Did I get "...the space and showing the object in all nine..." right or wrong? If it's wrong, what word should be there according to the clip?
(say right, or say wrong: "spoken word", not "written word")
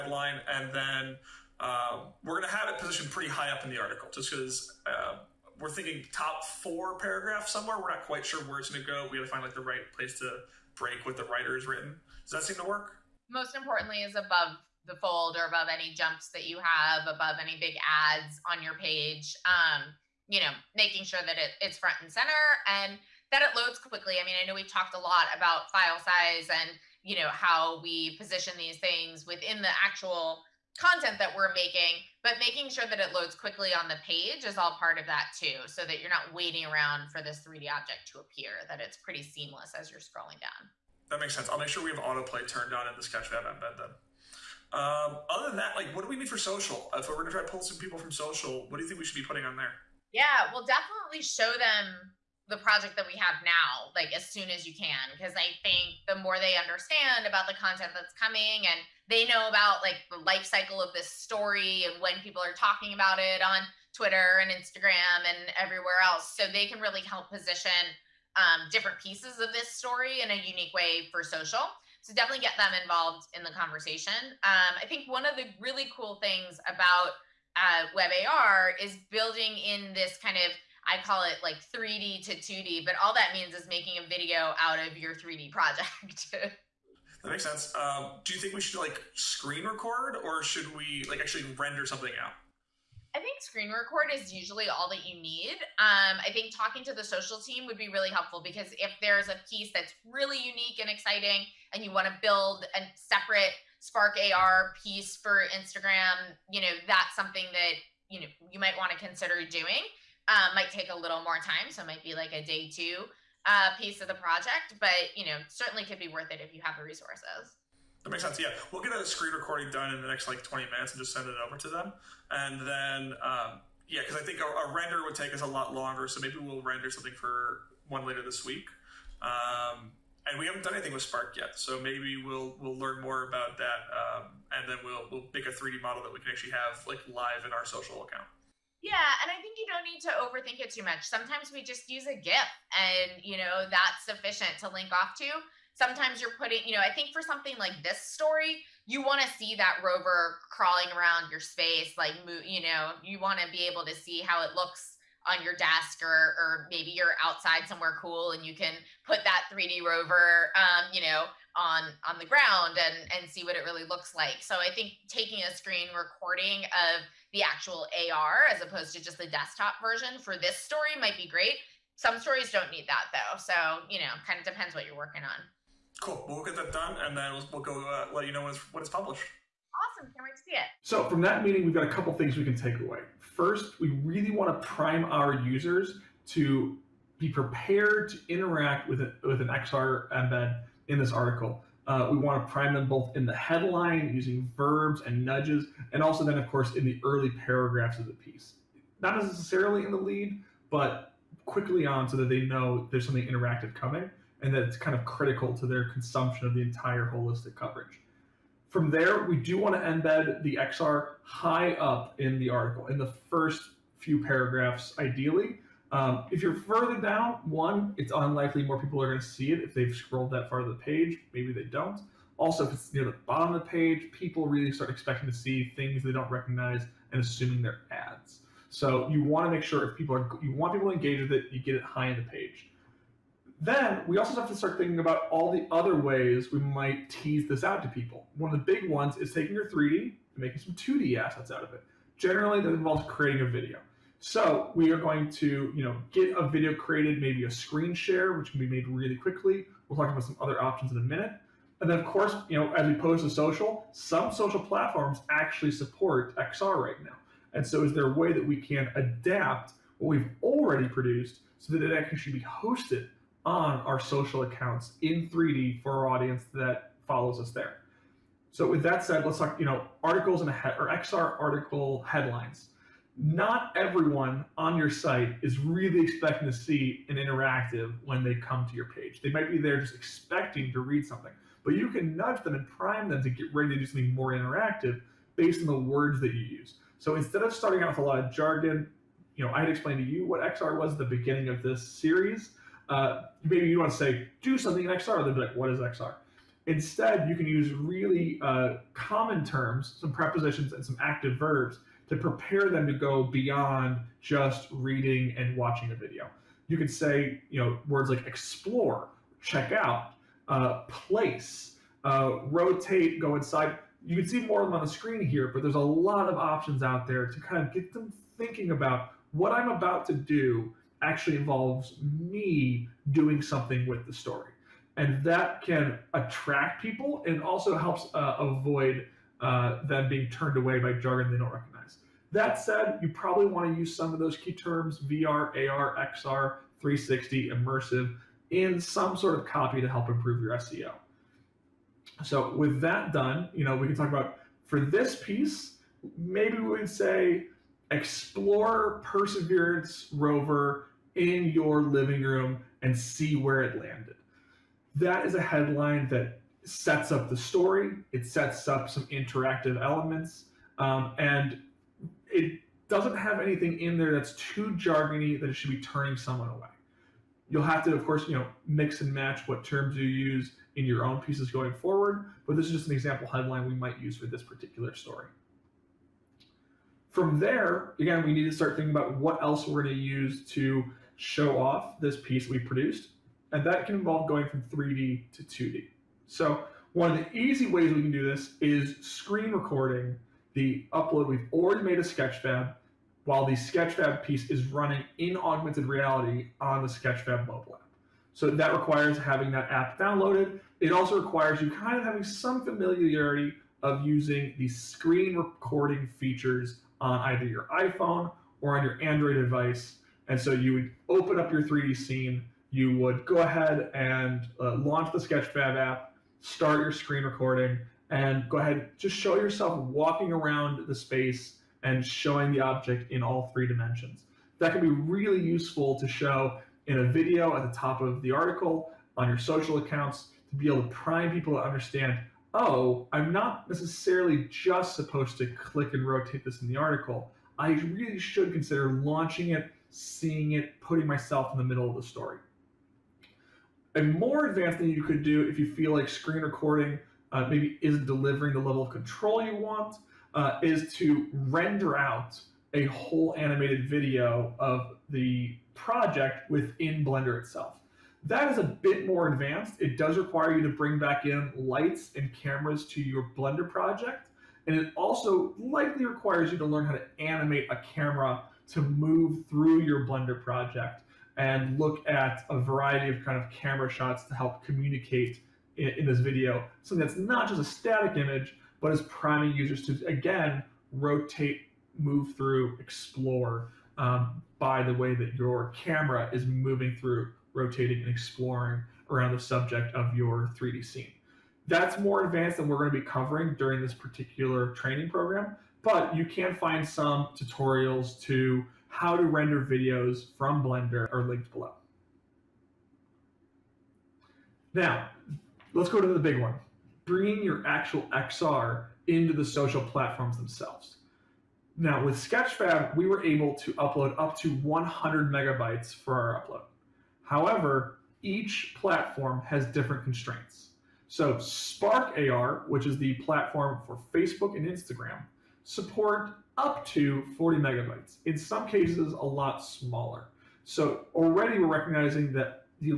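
wrong: "three", not "nine".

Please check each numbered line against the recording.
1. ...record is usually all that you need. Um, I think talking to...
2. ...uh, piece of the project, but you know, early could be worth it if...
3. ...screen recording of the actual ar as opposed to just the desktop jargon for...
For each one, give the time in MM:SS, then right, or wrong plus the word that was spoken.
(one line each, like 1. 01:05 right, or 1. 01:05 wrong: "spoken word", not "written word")
1. 01:33 right
2. 01:53 wrong: "certainly", not "early"
3. 02:45 wrong: "version", not "jargon".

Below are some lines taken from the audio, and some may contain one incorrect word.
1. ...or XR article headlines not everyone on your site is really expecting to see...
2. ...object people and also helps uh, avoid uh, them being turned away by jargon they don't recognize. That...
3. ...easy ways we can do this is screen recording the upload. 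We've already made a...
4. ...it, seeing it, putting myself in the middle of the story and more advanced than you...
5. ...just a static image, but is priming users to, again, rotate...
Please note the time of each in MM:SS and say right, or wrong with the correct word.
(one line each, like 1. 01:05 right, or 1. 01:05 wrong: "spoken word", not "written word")
1. 04:30 right
2. 05:26 wrong: "attract", not "object"
3. 06:27 right
4. 07:19 right
5. 07:57 right.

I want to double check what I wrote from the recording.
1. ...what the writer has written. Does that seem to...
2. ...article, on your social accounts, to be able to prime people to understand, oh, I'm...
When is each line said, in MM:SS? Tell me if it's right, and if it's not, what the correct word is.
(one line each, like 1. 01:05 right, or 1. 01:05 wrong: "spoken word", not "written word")
1. 00:11 right
2. 07:08 right.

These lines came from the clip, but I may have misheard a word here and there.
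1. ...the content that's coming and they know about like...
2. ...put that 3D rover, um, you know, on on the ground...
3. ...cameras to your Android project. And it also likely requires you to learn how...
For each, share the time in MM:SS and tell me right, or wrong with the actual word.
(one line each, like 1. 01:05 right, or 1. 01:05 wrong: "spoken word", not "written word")
1. 00:57 right
2. 02:39 right
3. 07:42 wrong: "Blender", not "Android".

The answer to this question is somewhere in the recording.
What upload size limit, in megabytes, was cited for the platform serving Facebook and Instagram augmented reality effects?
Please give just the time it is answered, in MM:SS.
08:47.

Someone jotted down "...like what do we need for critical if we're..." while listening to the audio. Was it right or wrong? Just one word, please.
wrong.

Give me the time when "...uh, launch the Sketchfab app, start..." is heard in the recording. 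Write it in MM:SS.
06:54.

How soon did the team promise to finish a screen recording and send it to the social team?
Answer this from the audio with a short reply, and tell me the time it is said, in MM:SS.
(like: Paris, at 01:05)
20 minutes, at 02:00.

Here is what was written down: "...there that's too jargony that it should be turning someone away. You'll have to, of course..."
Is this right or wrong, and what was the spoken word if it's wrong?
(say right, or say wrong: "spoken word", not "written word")
right.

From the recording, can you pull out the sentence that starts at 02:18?
Yeah, and I think you don't need to overthink it too much.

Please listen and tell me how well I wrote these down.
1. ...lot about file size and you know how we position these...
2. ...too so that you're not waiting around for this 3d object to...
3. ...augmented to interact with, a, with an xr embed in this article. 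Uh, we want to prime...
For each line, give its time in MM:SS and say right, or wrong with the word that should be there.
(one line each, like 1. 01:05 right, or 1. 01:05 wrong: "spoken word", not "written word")
1. 00:24 right
2. 00:35 right
3. 03:07 wrong: "prepared", not "augmented".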